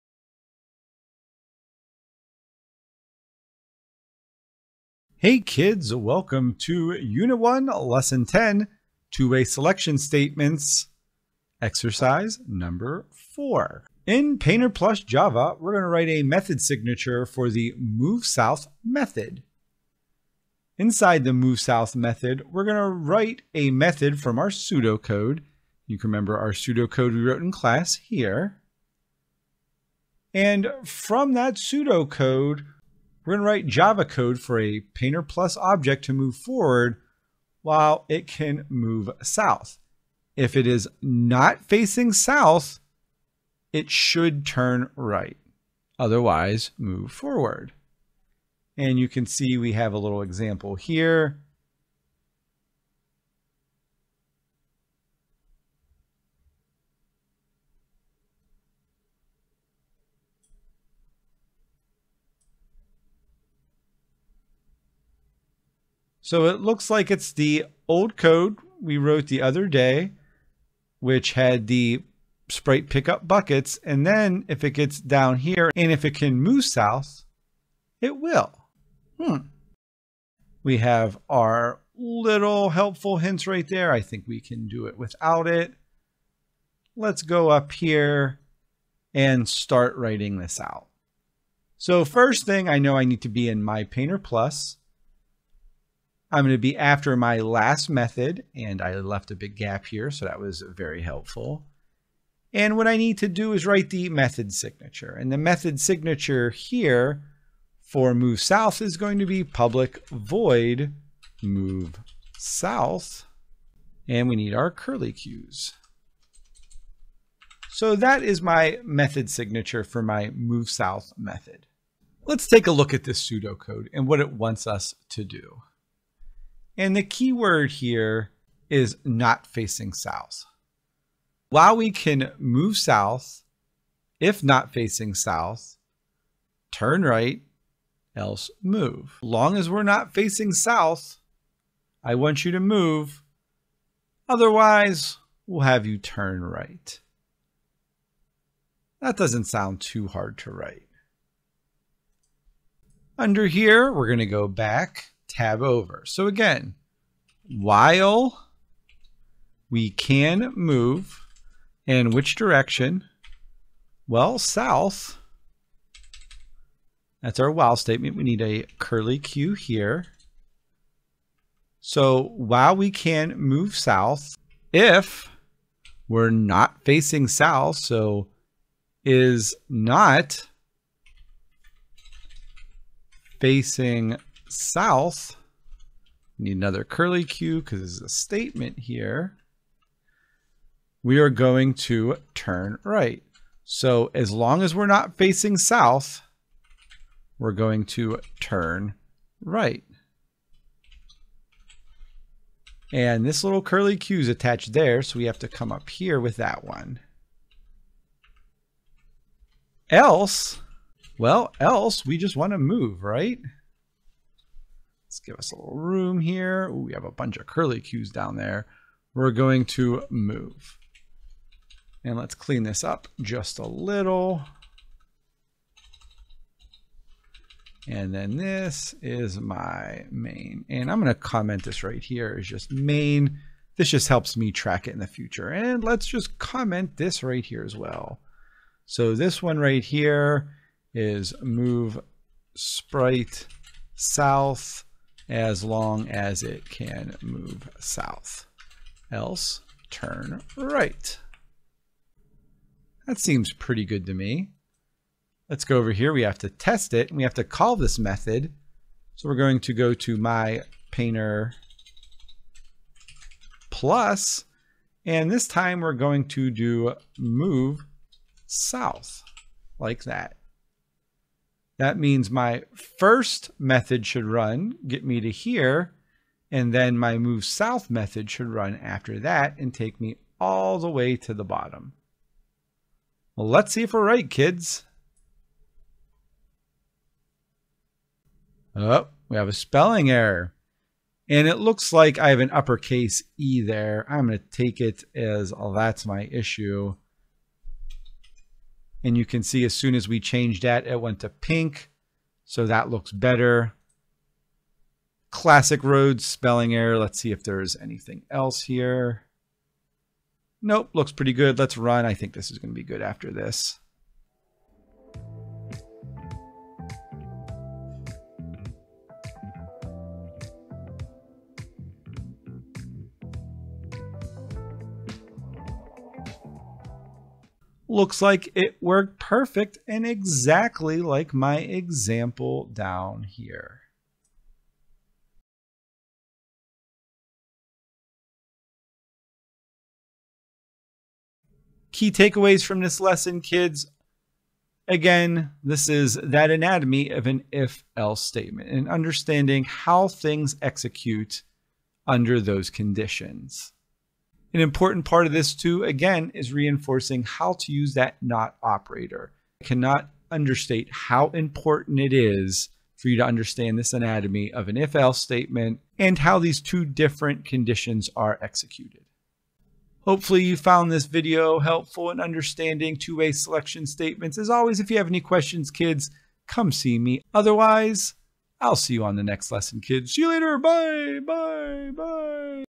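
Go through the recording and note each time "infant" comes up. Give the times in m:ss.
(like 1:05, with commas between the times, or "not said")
not said.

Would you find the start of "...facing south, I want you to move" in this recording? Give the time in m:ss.
2:20.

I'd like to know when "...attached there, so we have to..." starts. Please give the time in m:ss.
3:24.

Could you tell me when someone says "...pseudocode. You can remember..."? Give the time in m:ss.
0:24.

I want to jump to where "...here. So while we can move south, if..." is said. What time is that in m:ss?
2:49.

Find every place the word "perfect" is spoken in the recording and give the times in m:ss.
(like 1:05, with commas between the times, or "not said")
5:29.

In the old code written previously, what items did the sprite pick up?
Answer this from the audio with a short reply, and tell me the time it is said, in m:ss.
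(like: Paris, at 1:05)
buckets, at 1:13.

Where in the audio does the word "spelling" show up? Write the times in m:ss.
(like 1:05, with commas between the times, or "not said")
4:49, 5:06.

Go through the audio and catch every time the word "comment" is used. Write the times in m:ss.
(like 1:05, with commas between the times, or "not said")
3:51, 3:56.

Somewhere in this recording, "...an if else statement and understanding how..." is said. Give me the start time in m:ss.
5:47.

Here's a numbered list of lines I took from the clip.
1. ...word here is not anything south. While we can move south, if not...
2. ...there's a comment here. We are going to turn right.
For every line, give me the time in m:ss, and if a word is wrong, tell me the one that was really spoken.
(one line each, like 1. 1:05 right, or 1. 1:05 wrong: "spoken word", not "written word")
1. 2:07 wrong: "facing", not "anything"
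2. 3:07 wrong: "statement", not "comment".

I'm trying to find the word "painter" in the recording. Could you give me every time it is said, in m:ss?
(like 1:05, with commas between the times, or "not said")
0:14, 0:34, 1:33, 4:20.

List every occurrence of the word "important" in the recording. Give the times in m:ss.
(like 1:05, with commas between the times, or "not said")
5:54, 6:01.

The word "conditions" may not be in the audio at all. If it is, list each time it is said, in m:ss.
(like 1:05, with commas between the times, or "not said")
5:52, 6:07.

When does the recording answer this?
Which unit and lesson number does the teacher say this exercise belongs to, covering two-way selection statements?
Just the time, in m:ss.
0:06.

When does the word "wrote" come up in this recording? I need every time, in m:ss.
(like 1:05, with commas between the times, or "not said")
0:27, 1:08.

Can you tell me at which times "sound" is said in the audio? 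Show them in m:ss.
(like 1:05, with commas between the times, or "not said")
2:29.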